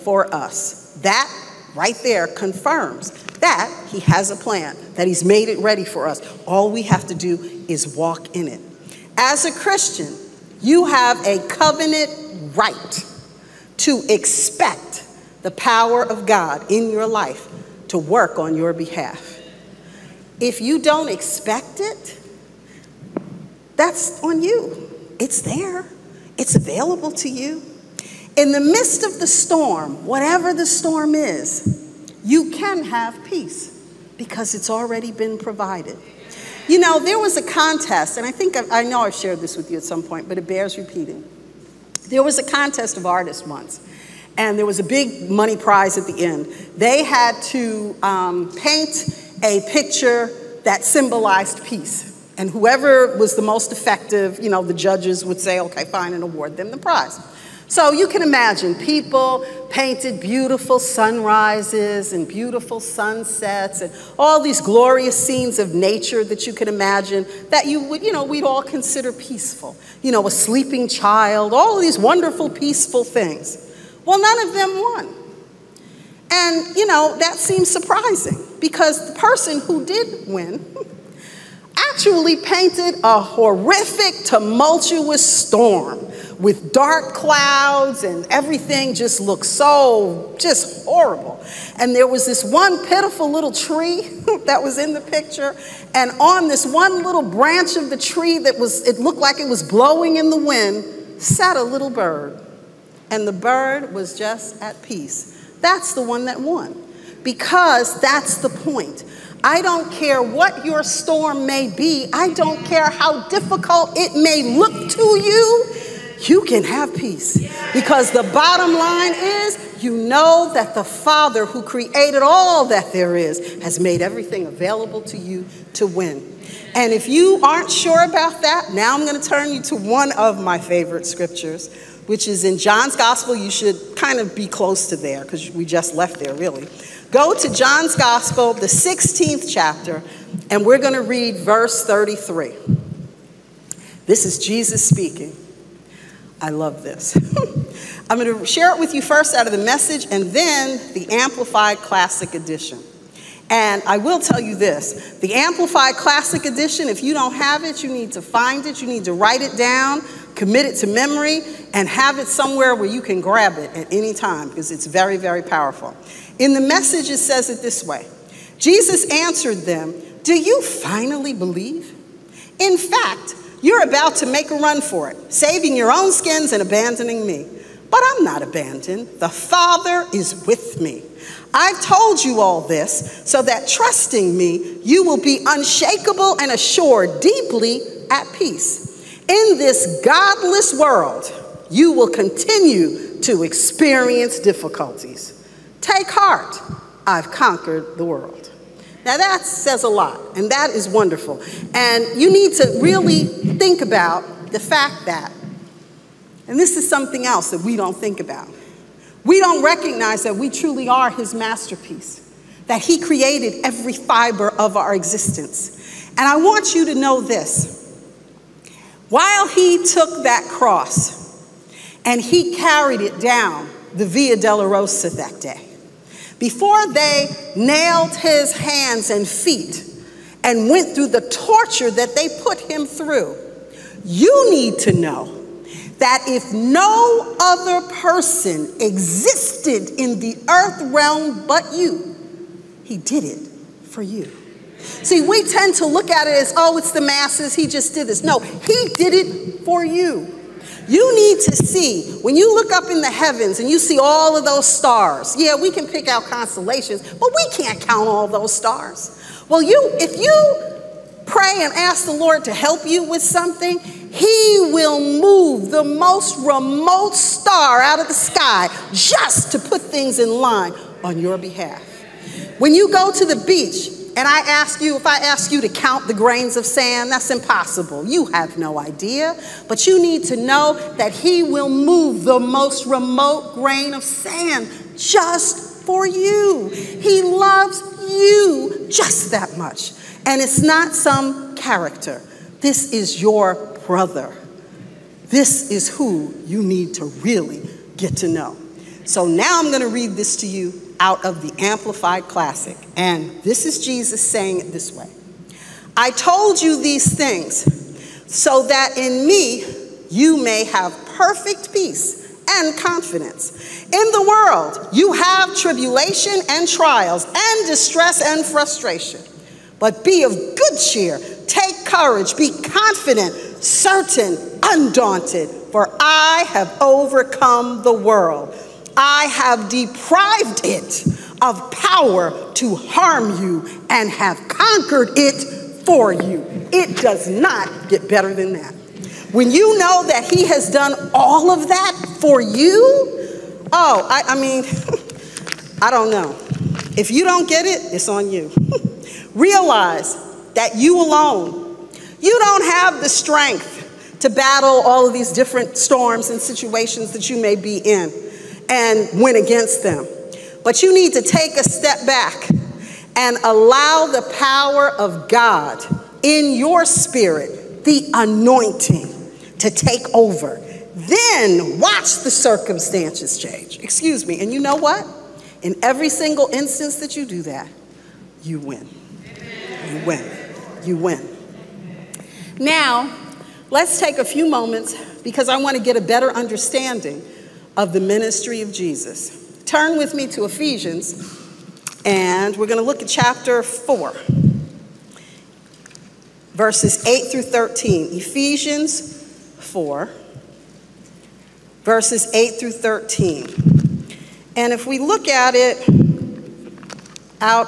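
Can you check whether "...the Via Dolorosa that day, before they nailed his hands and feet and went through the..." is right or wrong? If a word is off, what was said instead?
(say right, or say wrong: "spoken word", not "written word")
right.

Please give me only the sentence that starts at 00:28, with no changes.
In the midst of the storm, whatever the storm is, you can have peace because it's already been provided.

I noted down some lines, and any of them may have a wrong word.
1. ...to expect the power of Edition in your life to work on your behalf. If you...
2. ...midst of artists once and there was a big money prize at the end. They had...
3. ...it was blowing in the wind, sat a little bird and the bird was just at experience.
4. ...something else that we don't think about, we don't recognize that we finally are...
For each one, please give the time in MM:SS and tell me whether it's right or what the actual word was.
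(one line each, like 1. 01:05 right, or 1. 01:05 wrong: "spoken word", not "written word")
1. 00:13 wrong: "God", not "Edition"
2. 00:42 wrong: "contest", not "midst"
3. 01:39 wrong: "peace", not "experience"
4. 03:26 wrong: "truly", not "finally".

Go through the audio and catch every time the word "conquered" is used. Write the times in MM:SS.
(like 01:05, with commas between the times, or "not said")
03:17, 05:34.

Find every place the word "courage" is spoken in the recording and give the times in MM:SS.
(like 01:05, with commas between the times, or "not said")
05:21.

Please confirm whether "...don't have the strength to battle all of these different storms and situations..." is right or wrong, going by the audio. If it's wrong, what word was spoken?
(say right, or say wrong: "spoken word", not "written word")
right.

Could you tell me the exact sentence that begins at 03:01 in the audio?
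I've told you all this so that trusting me, you will be unshakable and assured, deeply at peace.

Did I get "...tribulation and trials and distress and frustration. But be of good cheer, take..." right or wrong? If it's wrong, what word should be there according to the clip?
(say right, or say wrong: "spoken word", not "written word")
right.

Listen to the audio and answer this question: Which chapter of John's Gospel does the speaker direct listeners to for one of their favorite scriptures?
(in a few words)
16th.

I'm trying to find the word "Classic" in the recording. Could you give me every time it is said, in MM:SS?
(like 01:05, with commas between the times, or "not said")
02:31, 02:35, 05:02.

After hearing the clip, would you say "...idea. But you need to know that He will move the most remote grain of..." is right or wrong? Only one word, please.
right.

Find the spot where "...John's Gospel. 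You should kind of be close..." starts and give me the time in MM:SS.
02:12.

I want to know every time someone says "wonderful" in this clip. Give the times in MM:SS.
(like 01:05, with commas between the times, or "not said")
01:11, 03:20.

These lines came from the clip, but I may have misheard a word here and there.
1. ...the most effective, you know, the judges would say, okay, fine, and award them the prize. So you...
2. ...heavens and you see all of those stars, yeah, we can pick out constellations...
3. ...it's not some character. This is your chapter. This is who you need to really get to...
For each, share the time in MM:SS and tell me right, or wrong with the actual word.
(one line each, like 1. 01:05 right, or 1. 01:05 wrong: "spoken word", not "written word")
1. 00:53 right
2. 04:13 right
3. 04:50 wrong: "brother", not "chapter".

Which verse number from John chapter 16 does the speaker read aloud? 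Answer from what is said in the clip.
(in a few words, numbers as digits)
33.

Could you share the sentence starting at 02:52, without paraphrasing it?
In fact, you're about to make a run for it, saving your own skins and abandoning me.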